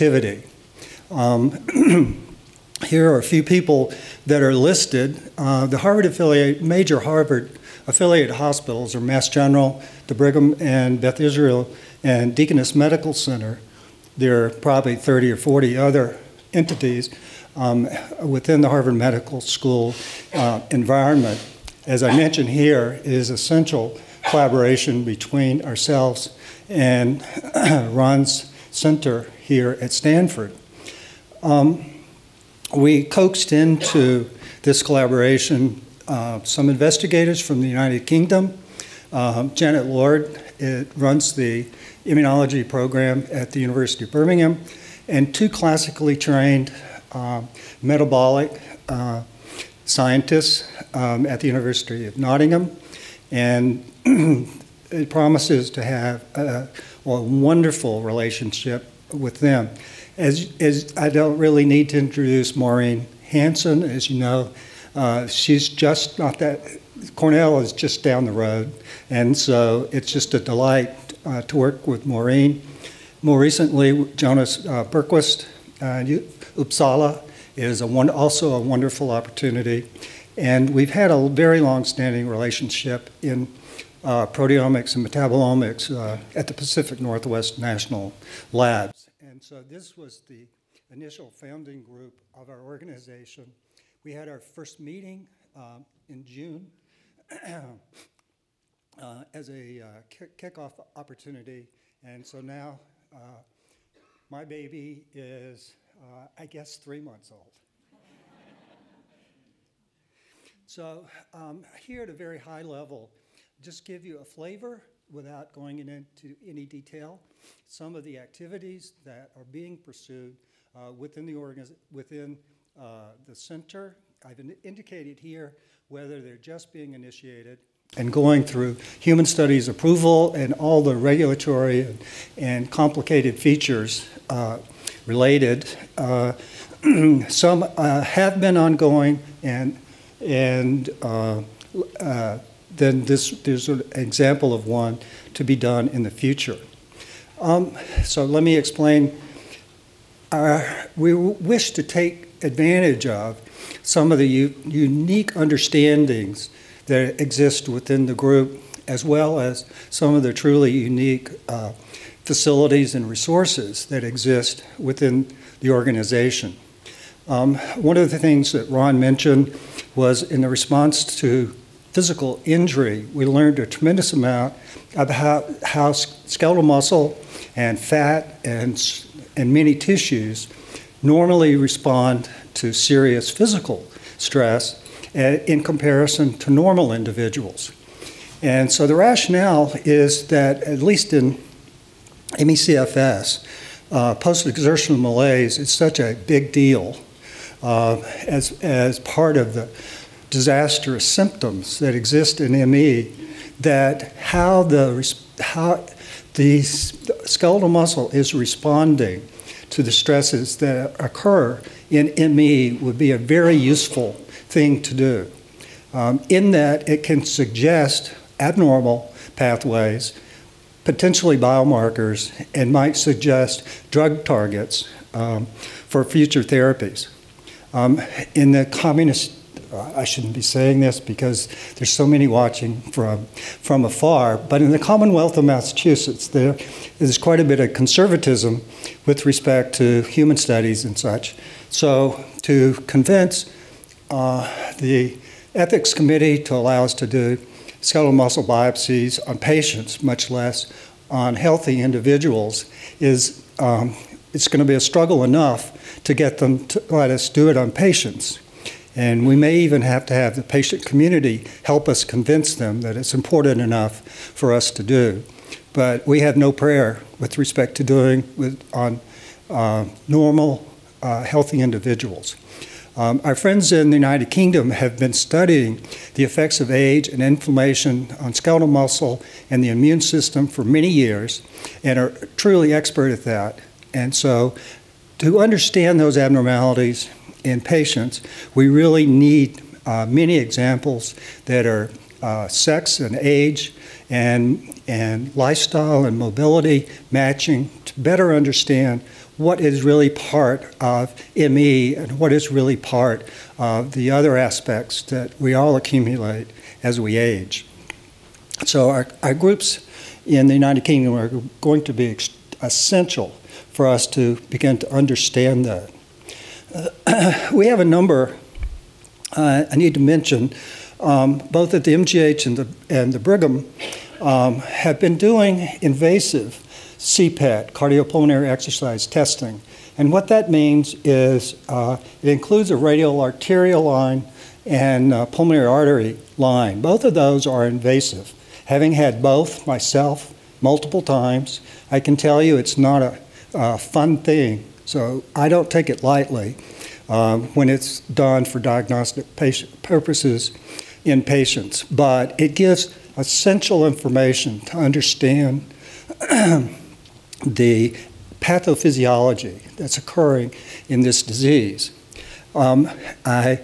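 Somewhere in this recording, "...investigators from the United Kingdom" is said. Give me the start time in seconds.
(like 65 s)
36 s.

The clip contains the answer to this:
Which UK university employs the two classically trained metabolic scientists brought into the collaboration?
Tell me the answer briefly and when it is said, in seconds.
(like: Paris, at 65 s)
University of Nottingham, at 51 s.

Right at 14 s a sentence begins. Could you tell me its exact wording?
There are probably 30 or 40 other entities um, within the Harvard Medical School uh, environment.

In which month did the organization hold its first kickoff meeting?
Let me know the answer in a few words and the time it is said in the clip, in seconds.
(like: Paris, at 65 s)
June, at 96 s.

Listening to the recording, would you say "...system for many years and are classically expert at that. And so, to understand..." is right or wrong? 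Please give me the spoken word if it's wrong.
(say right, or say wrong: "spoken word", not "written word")
wrong: "truly", not "classically".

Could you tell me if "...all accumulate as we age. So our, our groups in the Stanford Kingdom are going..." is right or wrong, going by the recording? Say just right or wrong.
wrong.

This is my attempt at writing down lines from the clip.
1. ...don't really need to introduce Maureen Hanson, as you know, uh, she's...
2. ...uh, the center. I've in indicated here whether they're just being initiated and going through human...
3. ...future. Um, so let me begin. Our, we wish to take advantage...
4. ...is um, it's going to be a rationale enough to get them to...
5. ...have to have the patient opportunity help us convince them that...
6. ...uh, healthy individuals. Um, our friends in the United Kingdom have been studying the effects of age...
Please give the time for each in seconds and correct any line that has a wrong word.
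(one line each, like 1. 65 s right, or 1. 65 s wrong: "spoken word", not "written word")
1. 61 s right
2. 122 s right
3. 146 s wrong: "explain", not "begin"
4. 253 s wrong: "struggle", not "rationale"
5. 259 s wrong: "community", not "opportunity"
6. 271 s right.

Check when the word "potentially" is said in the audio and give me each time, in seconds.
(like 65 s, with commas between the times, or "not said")
220 s.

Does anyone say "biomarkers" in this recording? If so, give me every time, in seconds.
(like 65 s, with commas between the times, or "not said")
221 s.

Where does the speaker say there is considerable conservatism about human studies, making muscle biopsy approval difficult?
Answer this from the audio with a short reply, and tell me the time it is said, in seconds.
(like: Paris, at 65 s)
Commonwealth of Massachusetts, at 234 s.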